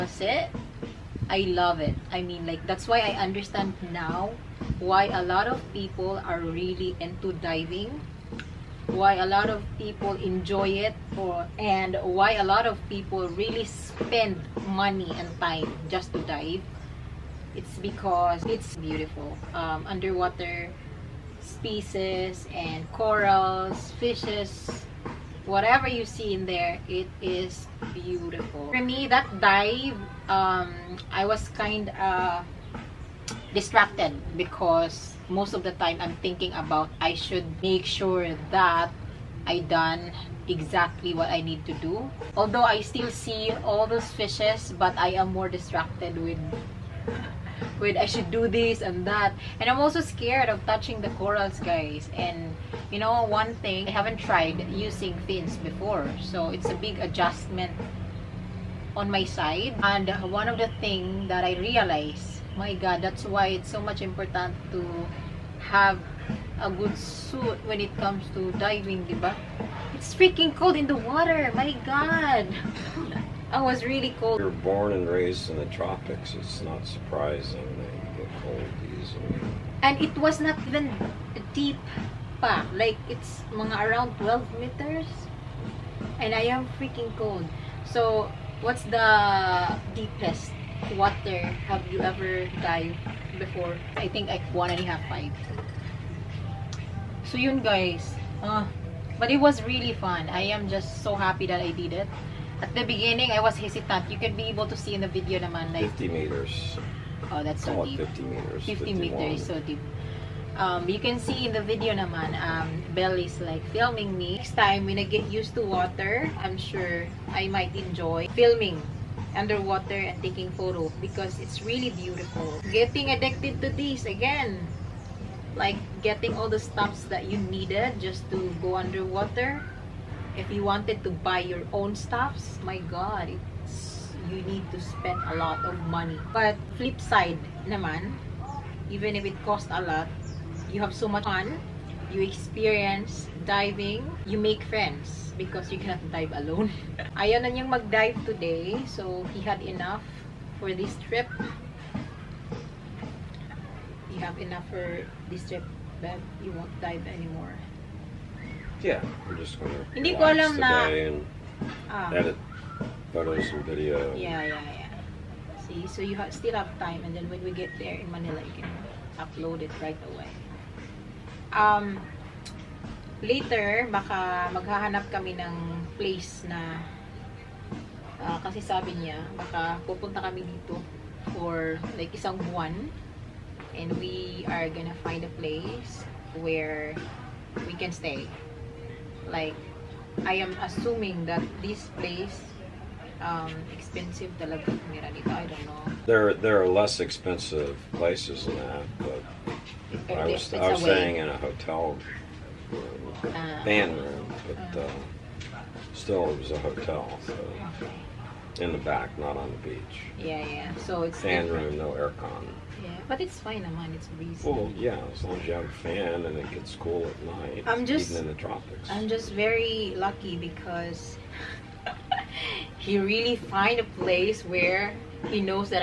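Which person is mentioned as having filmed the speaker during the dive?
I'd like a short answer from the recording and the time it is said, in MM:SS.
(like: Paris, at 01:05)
Belle, at 01:52.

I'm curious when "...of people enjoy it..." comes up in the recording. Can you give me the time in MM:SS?
00:09.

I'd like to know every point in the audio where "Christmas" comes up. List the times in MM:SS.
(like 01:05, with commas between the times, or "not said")
not said.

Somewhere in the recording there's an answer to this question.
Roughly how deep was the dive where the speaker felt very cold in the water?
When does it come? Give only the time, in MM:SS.
01:24.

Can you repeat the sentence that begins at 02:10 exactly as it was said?
If you wanted to buy your own stuffs, my God, it's, you need to spend a lot of money.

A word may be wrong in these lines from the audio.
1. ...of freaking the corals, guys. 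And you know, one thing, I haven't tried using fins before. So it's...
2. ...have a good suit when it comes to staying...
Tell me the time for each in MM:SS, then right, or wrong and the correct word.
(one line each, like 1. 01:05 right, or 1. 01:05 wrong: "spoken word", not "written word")
1. 00:50 wrong: "touching", not "freaking"
2. 01:05 wrong: "diving", not "staying".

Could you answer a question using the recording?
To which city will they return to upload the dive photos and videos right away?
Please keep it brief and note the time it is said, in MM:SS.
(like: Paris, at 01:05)
Manila, at 02:48.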